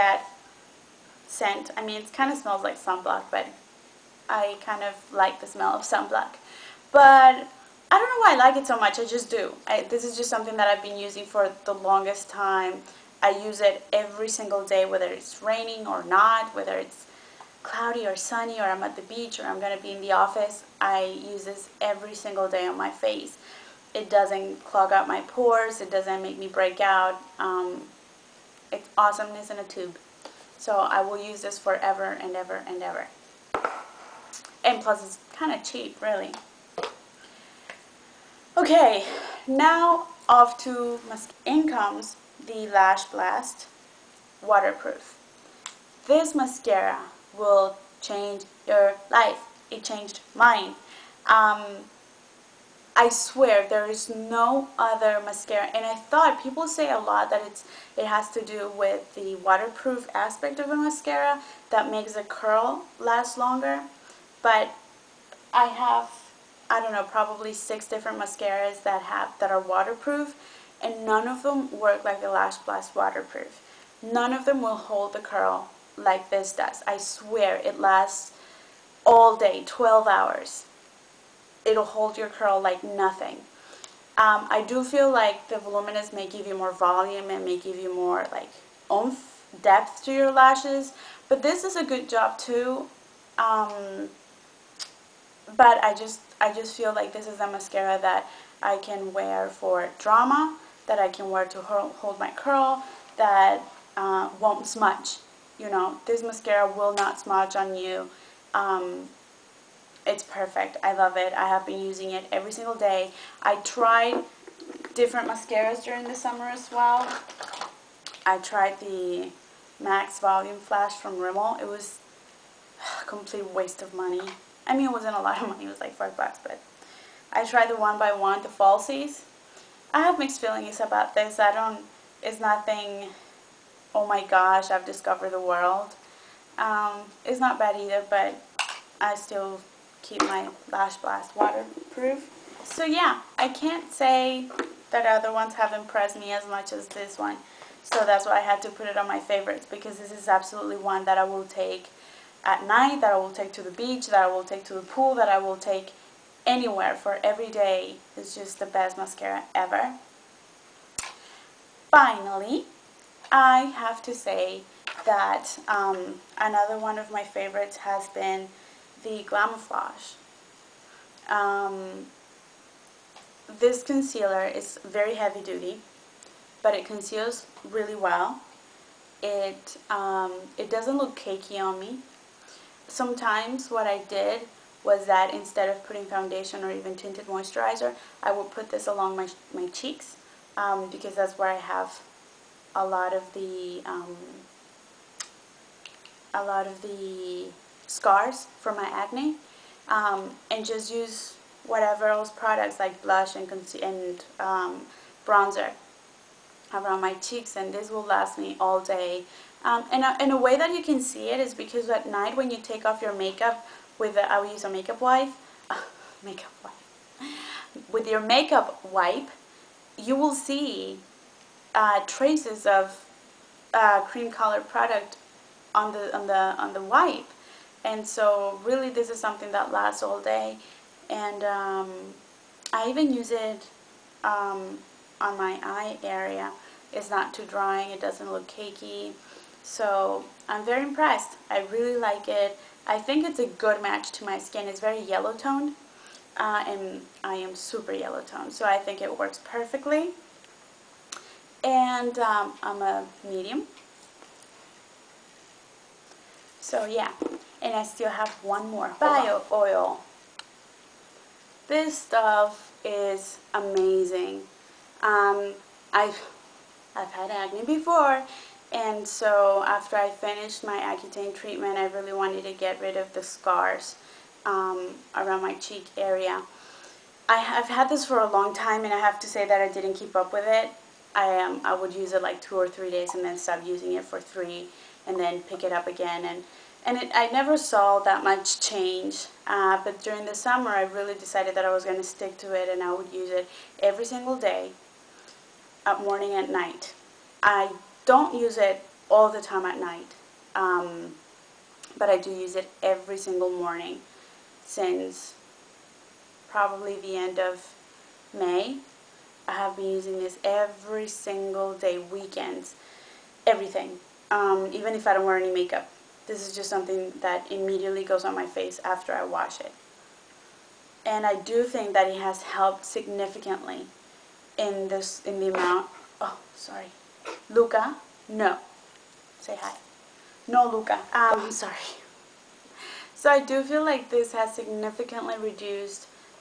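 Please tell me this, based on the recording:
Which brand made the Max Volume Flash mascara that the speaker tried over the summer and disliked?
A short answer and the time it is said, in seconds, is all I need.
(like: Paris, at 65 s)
Rimmel, at 121 s.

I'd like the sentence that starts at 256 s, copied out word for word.
So yeah, and I still have one more bio oil.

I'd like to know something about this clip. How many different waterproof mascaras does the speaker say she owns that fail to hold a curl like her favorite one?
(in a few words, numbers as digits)
6.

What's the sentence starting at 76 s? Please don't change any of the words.
I swear it lasts all day, 12 hours.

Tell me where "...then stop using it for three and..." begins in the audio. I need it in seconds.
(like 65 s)
283 s.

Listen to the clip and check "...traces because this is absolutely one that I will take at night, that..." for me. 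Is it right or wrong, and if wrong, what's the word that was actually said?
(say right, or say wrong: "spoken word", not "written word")
wrong: "favorites", not "traces".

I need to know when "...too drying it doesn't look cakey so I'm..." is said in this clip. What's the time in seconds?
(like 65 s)
237 s.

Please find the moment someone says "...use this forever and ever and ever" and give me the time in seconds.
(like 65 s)
31 s.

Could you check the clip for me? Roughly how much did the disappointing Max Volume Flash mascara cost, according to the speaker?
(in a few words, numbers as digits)
5 bucks.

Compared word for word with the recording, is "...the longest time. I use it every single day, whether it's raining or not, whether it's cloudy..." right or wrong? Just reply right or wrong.
right.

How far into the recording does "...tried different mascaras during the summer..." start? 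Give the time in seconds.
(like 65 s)
113 s.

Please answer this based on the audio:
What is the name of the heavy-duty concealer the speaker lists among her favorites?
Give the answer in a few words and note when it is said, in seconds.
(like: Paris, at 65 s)
Glamouflage, at 169 s.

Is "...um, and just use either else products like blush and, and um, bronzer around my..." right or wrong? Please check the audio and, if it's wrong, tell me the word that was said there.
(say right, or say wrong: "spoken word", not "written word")
wrong: "whatever", not "either".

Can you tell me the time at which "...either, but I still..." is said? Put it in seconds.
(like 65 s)
137 s.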